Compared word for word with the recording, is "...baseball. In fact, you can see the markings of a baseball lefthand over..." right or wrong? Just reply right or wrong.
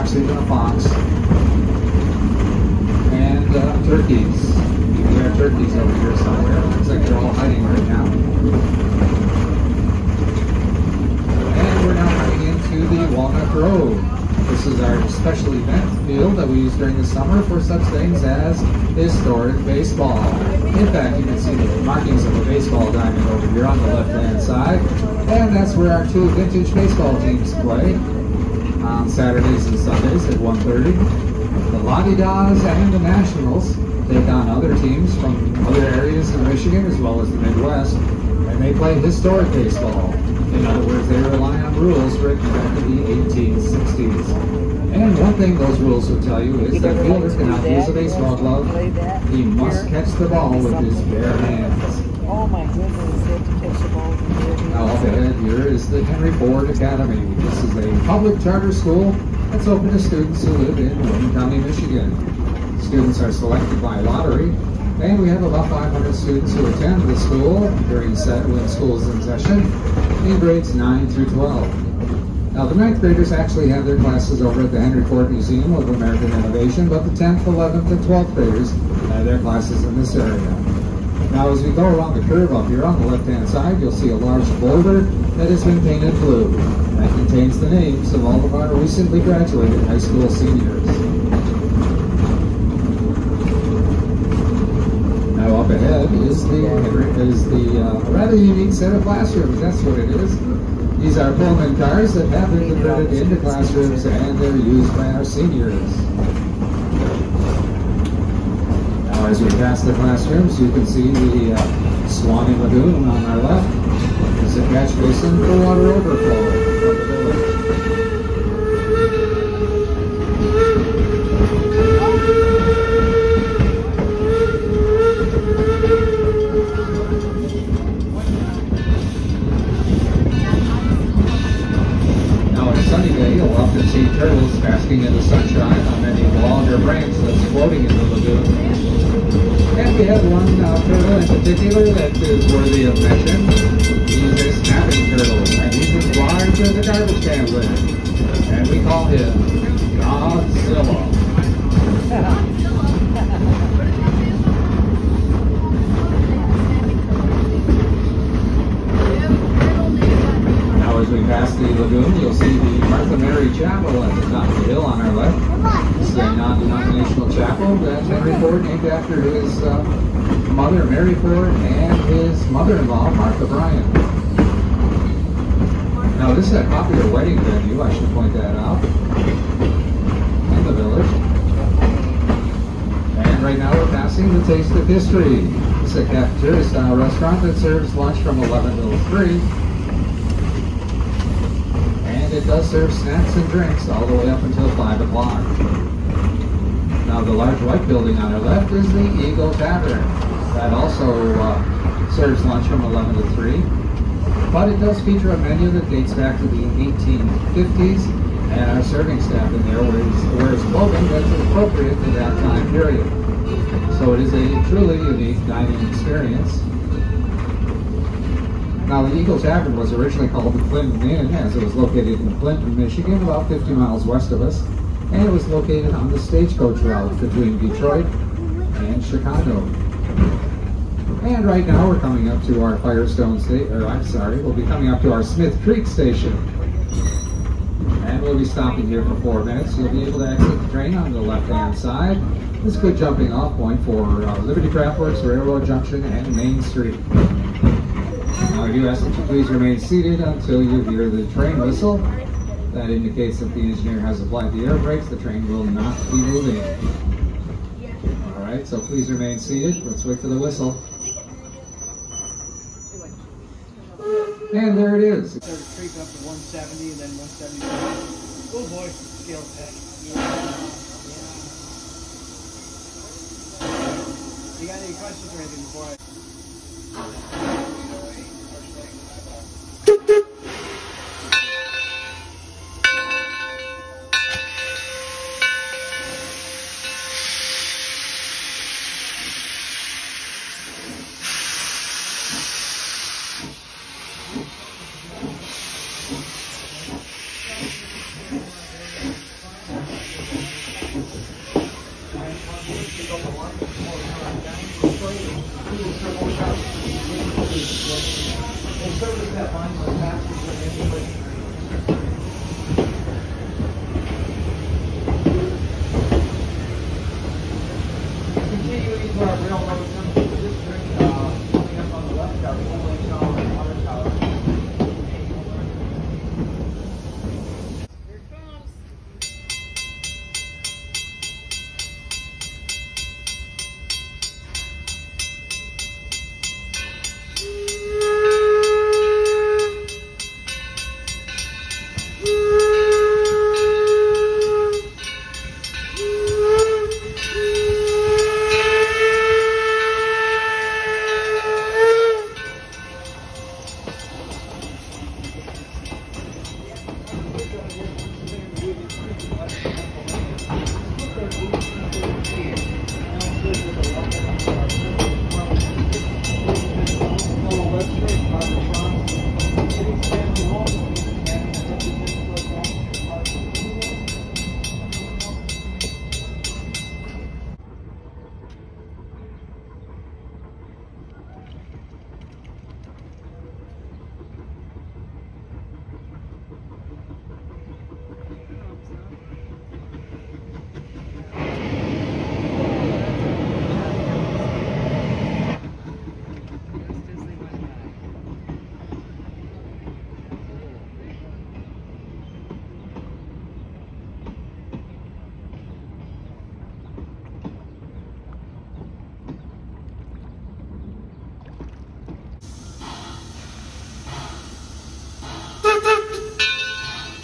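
wrong.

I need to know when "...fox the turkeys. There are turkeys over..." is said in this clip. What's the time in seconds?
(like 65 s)
0 s.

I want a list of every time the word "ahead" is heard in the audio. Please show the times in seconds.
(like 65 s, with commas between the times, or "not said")
55 s, 95 s.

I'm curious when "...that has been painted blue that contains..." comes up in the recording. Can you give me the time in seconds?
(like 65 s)
85 s.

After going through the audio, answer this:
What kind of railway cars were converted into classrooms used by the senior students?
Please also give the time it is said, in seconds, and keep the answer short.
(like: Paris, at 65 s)
Pullman cars, at 101 s.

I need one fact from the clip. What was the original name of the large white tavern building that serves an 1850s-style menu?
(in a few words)
Clinton Inn.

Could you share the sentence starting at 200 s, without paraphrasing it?
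That also uh, serves lunch from 11 to 3.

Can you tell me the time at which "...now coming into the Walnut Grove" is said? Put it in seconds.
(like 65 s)
11 s.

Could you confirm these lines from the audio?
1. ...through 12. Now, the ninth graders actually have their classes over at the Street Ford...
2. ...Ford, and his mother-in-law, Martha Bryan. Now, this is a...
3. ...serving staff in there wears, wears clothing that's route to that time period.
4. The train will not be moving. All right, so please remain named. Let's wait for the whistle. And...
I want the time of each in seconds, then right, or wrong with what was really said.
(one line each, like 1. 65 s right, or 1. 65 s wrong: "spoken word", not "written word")
1. 71 s wrong: "Henry", not "Street"
2. 171 s right
3. 208 s wrong: "appropriate", not "route"
4. 255 s wrong: "seated", not "named".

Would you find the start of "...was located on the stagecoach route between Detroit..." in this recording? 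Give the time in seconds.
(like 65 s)
225 s.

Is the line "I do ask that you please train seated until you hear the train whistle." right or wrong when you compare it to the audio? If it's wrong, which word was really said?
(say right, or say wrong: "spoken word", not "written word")
wrong: "remain", not "train".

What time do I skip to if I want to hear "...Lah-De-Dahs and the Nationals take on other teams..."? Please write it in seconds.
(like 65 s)
31 s.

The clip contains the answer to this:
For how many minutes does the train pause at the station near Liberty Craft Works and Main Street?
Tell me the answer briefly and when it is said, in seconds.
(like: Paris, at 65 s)
4, at 239 s.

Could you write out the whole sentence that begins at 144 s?
He's a snapping turtle, and he's as large as a garbage can lid.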